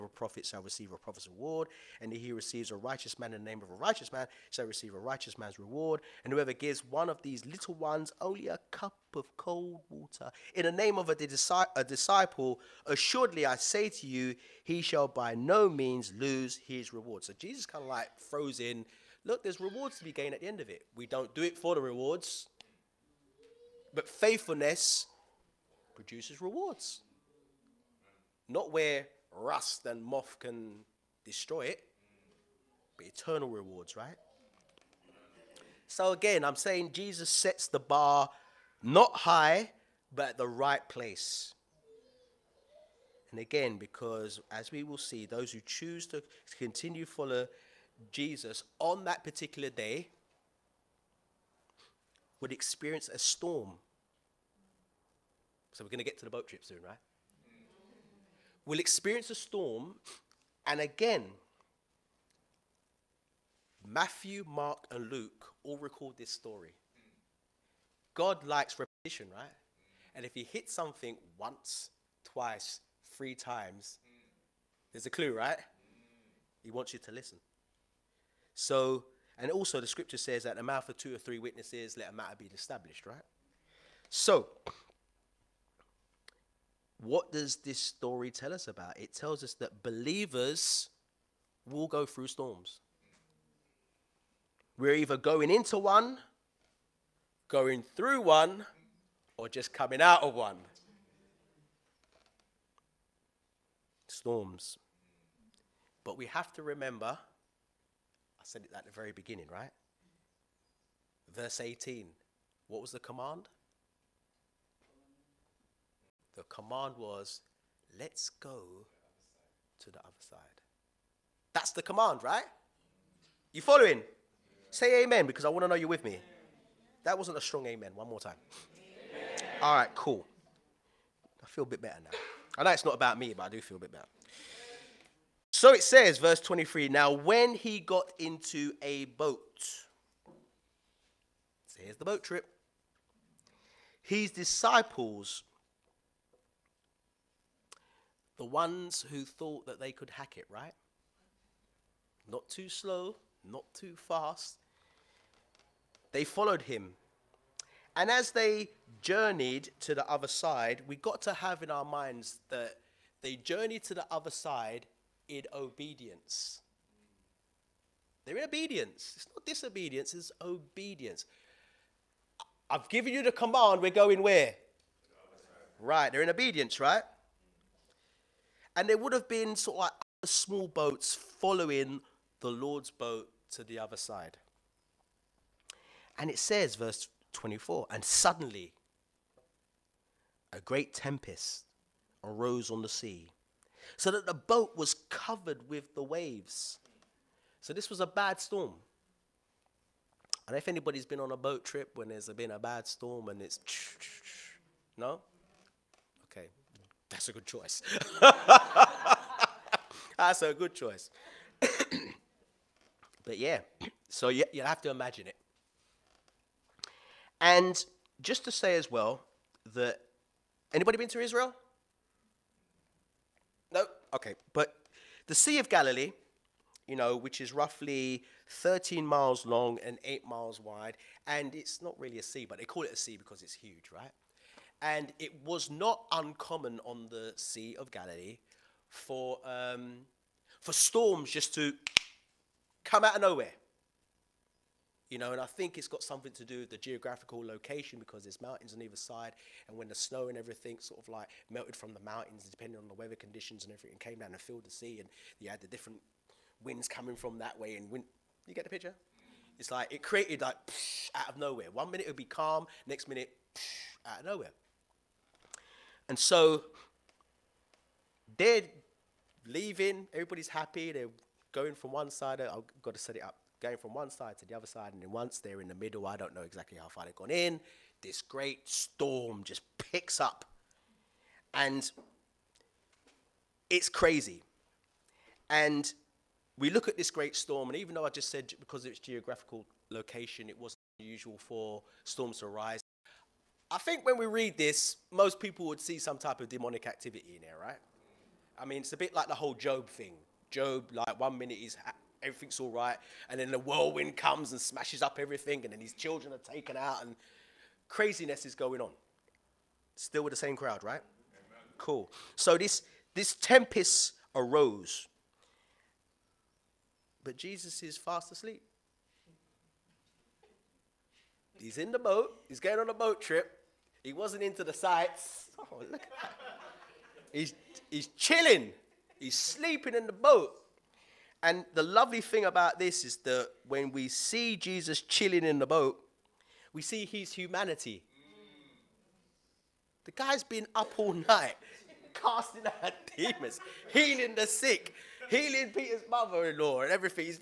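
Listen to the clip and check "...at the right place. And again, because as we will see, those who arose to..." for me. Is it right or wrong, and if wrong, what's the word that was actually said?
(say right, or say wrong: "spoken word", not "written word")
wrong: "choose", not "arose".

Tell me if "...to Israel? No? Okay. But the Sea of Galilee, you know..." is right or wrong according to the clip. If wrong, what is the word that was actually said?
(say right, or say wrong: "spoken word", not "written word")
right.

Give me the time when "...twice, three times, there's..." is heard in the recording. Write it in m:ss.
1:12.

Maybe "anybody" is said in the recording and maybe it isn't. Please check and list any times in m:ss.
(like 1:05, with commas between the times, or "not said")
3:20, 3:40.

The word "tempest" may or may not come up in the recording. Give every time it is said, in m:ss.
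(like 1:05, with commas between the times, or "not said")
3:10, 5:13.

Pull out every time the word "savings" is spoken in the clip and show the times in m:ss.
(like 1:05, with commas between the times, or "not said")
not said.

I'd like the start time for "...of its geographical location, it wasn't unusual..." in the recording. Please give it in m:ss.
4:48.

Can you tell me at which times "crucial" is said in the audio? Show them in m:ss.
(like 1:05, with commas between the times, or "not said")
not said.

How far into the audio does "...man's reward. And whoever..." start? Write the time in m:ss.
0:05.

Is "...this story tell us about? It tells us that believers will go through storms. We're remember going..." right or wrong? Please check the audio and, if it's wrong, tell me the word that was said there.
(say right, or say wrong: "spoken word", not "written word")
wrong: "either", not "remember".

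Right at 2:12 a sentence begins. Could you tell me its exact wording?
I know it's not about me, but I do feel a bit better.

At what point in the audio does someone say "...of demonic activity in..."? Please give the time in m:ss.
4:56.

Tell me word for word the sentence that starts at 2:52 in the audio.
I've given you the command, we're going where?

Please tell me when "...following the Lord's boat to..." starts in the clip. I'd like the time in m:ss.
3:01.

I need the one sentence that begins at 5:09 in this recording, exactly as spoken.
Still with the same crowd, right?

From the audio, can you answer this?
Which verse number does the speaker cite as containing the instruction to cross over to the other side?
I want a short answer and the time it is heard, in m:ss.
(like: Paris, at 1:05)
18, at 1:51.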